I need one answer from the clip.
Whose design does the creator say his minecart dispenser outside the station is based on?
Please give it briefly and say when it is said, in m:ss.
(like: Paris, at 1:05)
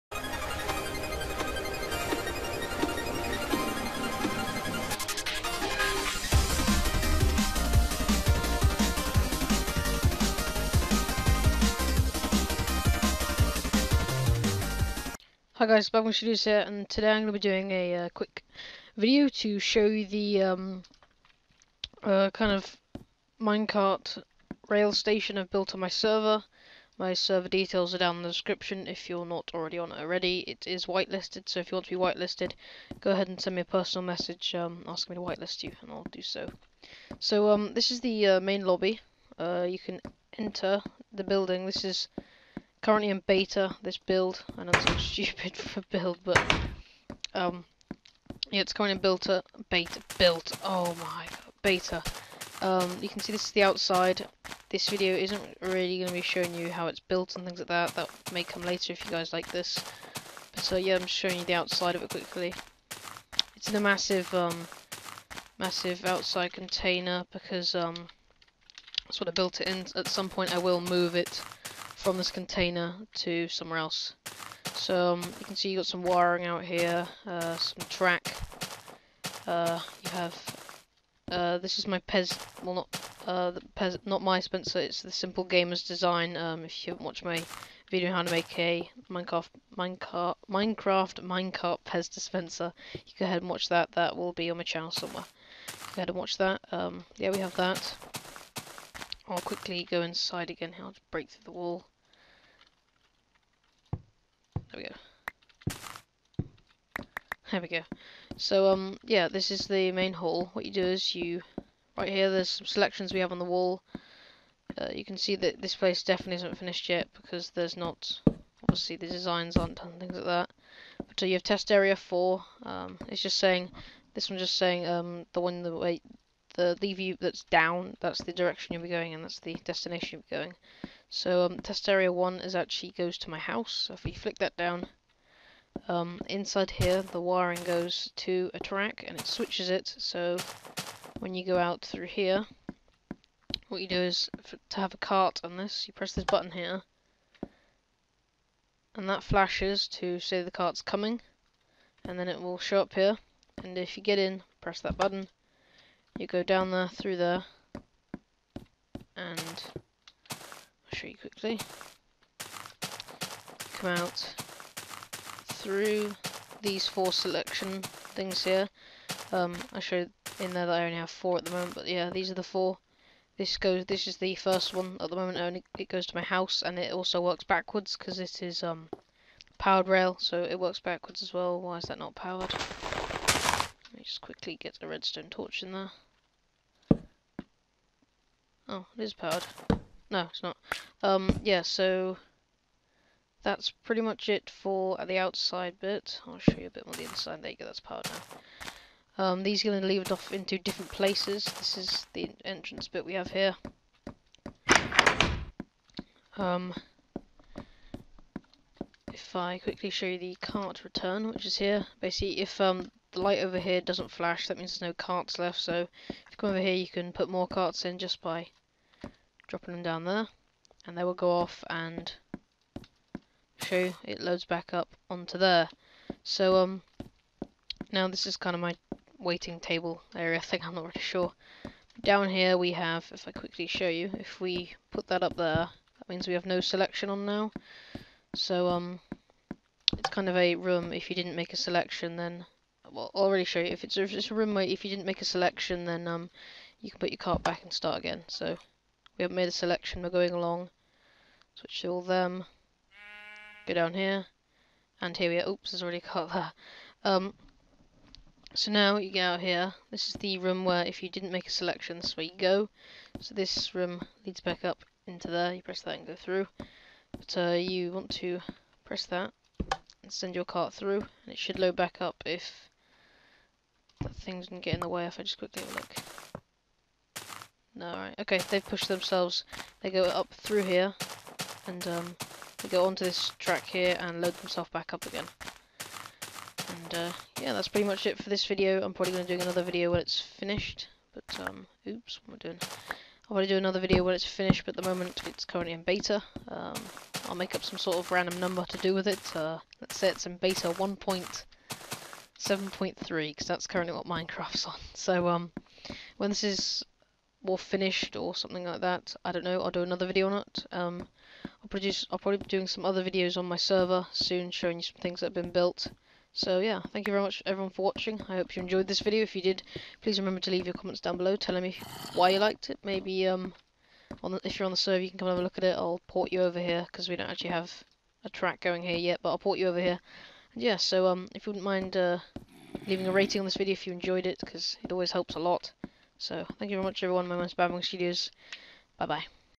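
Simple Gamers, at 1:25.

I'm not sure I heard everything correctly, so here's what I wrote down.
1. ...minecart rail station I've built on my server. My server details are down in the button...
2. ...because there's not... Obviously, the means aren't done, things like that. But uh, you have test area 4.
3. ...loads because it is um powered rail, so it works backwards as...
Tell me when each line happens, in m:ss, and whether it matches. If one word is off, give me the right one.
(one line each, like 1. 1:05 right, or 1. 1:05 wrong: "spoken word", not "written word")
1. 0:23 wrong: "description", not "button"
2. 1:57 wrong: "designs", not "means"
3. 2:57 wrong: "backwards", not "loads".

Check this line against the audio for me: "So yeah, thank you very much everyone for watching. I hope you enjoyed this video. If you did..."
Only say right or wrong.
right.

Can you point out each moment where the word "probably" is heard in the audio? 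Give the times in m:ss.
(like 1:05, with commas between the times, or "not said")
4:48, 5:12.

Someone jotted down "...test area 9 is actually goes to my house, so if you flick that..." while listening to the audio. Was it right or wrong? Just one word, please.
wrong.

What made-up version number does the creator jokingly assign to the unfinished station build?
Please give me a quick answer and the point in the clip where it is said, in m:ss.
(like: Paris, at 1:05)
beta 1.7.3, at 5:00.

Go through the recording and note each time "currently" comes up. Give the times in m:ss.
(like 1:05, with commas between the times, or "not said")
0:42, 0:48, 4:55, 5:03.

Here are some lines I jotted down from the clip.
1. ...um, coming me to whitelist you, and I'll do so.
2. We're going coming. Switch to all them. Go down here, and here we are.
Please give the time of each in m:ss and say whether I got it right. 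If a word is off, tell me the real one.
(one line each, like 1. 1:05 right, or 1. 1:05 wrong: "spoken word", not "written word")
1. 0:34 wrong: "asking", not "coming"
2. 4:10 wrong: "along", not "coming".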